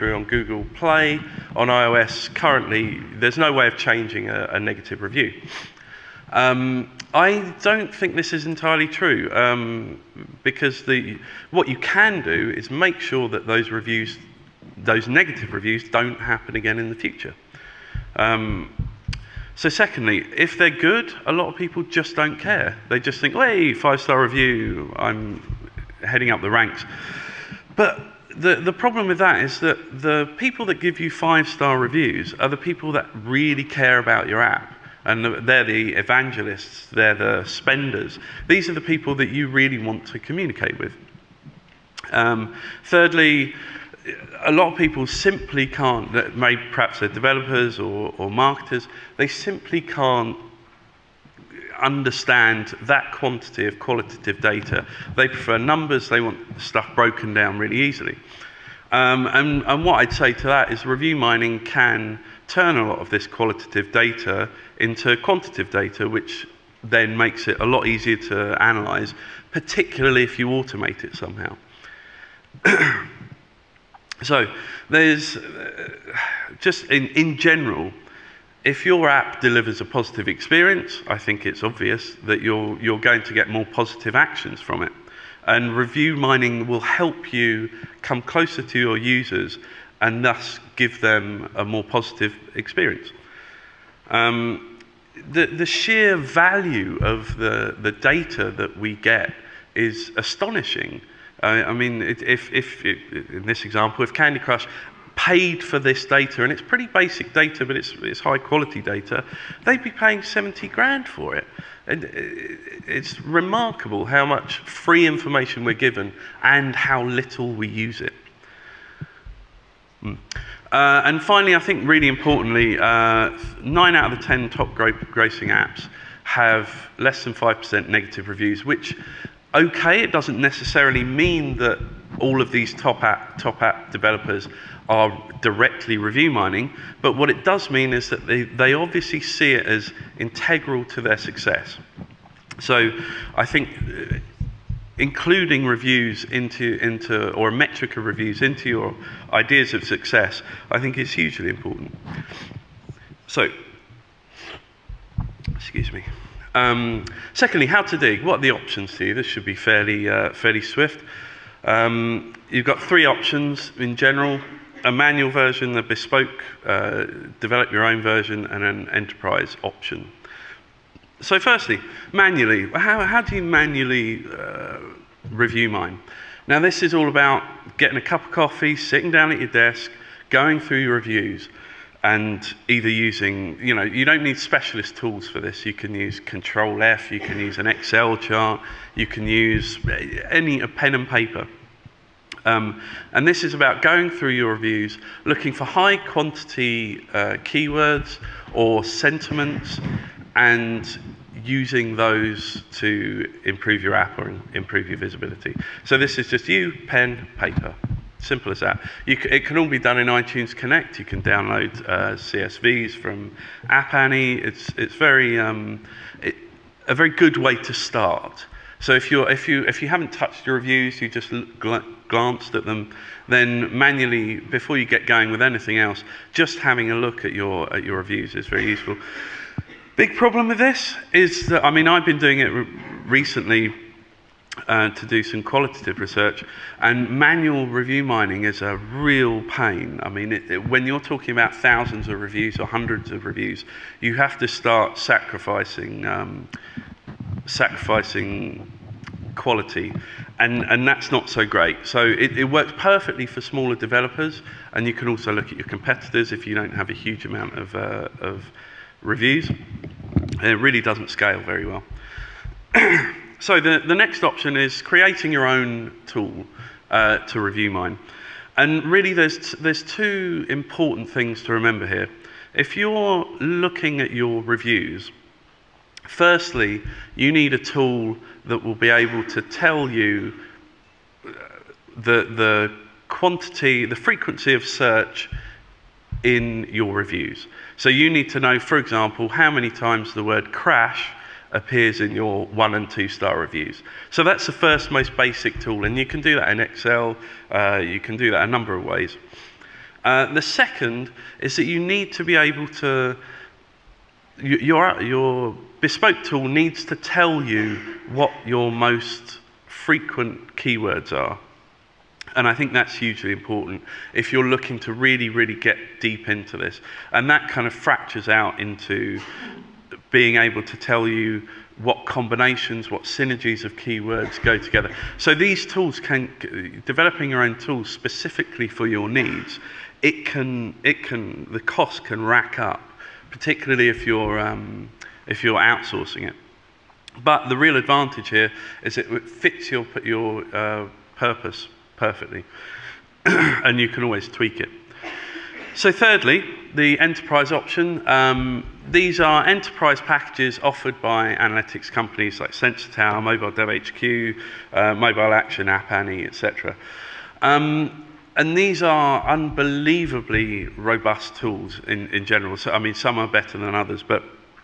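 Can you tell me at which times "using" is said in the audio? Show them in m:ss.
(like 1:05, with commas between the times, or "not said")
3:02, 3:21.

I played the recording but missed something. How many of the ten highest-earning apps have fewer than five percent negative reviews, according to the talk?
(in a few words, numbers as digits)
9.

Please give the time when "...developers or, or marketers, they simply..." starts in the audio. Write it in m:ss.
0:47.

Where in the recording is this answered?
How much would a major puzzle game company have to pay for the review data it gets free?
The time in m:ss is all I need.
1:50.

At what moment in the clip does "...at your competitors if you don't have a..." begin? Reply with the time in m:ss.
4:15.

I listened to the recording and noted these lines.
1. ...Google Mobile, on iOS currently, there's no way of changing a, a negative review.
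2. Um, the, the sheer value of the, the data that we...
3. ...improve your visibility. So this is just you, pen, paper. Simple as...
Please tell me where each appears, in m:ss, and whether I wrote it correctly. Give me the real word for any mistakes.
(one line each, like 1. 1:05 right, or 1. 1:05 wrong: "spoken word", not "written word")
1. 0:00 wrong: "Play", not "Mobile"
2. 1:34 right
3. 3:24 right.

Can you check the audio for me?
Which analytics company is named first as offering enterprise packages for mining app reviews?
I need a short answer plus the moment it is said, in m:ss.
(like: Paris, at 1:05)
Sensor Tower, at 5:52.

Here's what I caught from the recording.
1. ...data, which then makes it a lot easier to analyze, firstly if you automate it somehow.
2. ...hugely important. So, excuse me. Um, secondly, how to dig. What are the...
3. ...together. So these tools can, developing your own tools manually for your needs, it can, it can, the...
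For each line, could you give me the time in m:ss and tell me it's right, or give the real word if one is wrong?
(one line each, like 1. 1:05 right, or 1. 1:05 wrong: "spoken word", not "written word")
1. 1:05 wrong: "particularly", not "firstly"
2. 2:31 right
3. 5:24 wrong: "specifically", not "manually".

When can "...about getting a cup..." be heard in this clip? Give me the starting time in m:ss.
2:57.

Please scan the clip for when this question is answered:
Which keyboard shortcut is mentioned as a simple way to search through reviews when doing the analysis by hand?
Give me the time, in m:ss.
3:06.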